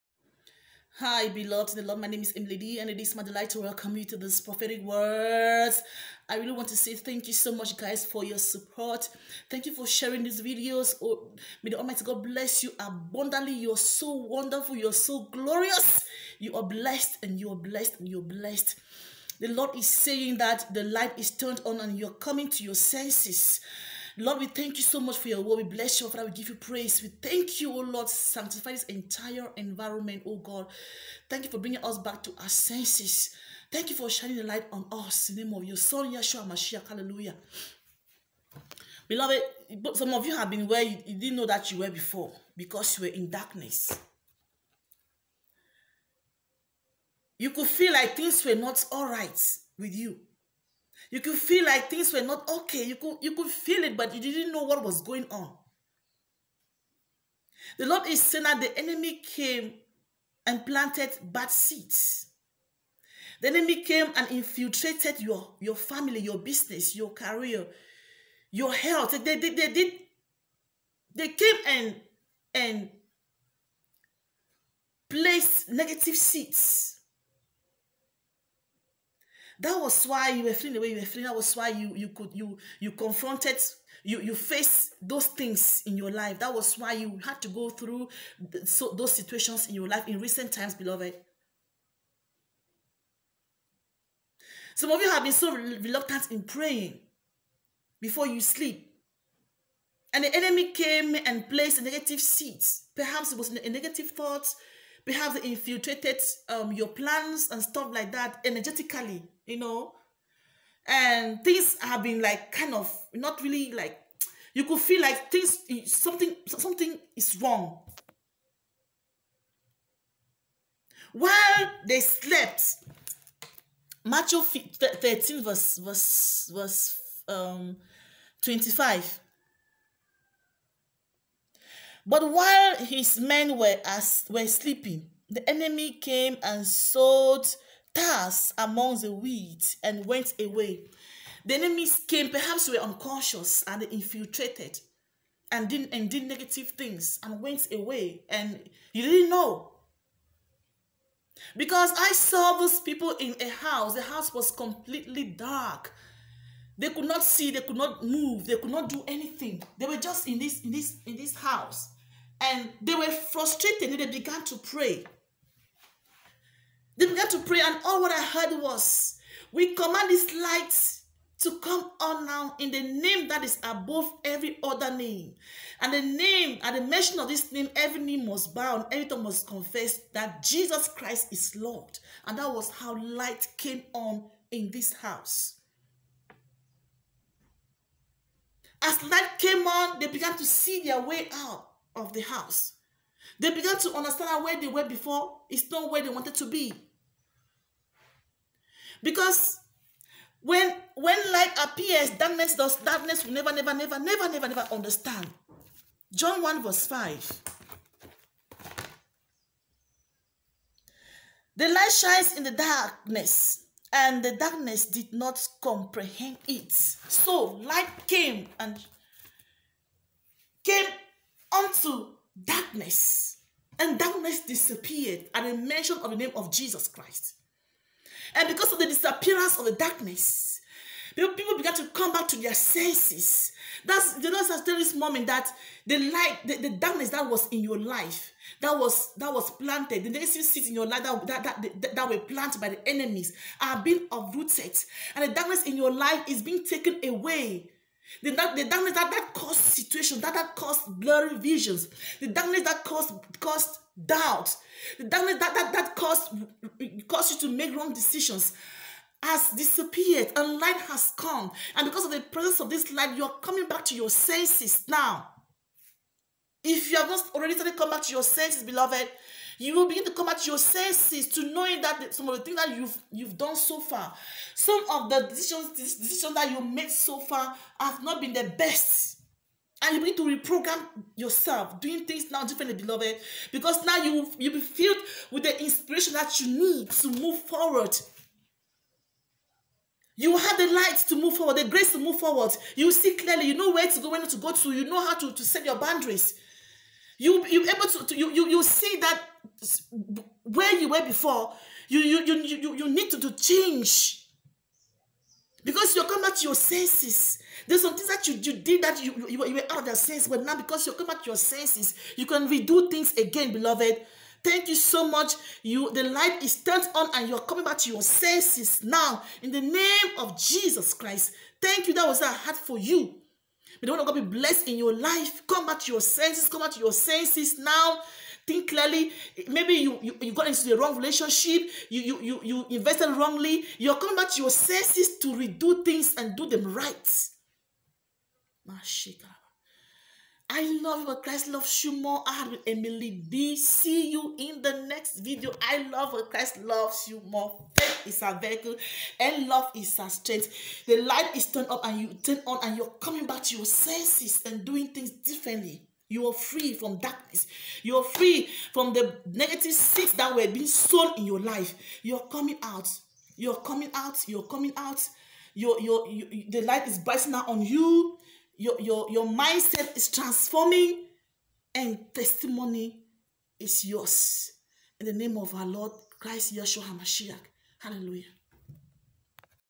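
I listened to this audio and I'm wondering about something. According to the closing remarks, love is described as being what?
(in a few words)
A strength.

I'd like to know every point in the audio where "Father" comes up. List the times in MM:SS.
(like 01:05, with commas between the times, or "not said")
00:26.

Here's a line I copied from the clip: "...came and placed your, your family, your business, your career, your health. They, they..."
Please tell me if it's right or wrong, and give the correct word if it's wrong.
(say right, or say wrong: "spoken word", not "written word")
wrong: "infiltrated", not "placed".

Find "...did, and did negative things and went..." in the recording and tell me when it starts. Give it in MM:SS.
02:25.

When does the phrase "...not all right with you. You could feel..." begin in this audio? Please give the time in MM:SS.
00:48.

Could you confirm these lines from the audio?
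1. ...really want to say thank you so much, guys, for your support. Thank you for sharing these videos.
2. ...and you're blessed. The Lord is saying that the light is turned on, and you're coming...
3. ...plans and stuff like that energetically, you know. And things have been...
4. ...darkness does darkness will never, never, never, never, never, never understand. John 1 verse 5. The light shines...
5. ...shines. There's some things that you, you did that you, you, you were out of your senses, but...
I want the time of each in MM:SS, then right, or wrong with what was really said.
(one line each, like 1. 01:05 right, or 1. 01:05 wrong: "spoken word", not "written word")
1. 00:06 right
2. 00:17 right
3. 01:46 right
4. 03:22 right
5. 05:06 wrong: "senses", not "shines".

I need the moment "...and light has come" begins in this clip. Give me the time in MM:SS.
04:20.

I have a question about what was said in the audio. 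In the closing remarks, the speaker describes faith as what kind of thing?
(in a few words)
A vehicle.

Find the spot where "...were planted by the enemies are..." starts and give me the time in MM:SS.
04:02.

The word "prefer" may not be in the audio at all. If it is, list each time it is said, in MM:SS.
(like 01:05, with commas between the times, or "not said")
not said.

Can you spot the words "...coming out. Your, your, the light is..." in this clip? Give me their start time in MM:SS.
06:04.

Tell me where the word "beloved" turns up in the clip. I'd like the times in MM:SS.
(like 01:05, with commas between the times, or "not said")
00:01, 00:39, 01:30, 04:28, 04:42, 05:13.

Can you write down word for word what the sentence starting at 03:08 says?
As light came on, they began to see their way out of the house.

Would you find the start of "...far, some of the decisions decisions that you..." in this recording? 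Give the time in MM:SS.
04:33.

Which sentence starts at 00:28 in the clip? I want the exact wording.
Sanctify this entire environment, oh God.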